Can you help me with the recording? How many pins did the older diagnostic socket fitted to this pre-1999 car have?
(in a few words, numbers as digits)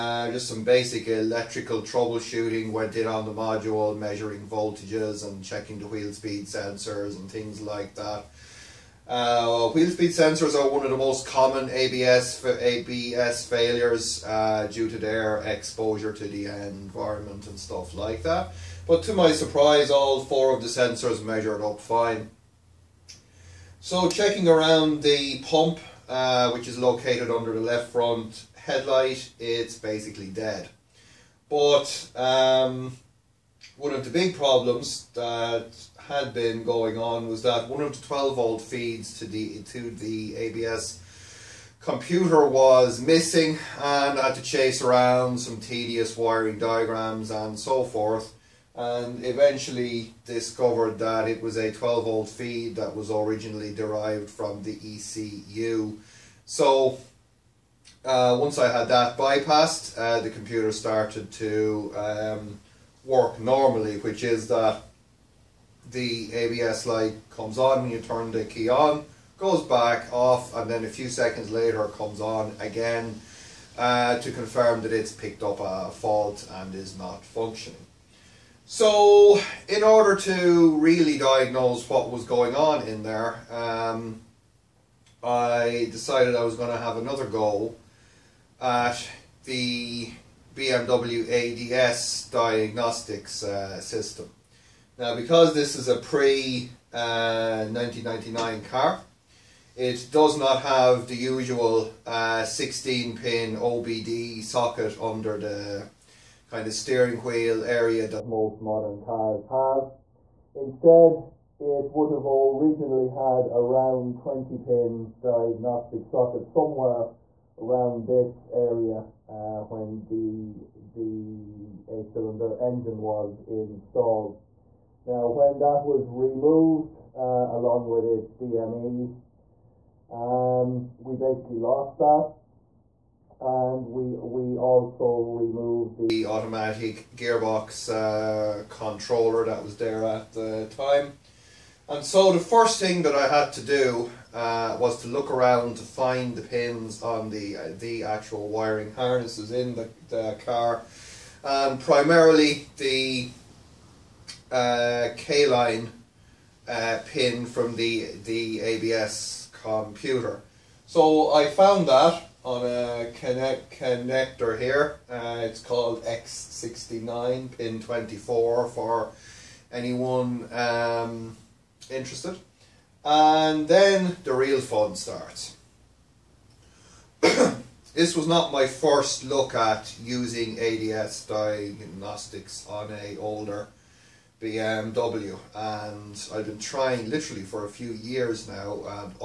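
20.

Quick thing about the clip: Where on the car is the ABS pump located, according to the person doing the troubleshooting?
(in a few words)
Under the left front headlight.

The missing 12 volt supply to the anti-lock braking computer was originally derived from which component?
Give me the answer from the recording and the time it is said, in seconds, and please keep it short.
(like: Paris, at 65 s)
ECU, at 54 s.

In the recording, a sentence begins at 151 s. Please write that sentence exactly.
And um, primarily the uh, K line uh, pin from the, the ABS computer.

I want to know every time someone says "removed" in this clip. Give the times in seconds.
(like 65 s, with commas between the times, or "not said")
126 s, 135 s.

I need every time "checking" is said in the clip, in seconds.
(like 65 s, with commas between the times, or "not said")
5 s, 24 s.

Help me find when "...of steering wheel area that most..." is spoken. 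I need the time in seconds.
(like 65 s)
106 s.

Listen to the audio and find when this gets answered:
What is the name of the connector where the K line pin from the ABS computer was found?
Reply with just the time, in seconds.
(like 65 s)
166 s.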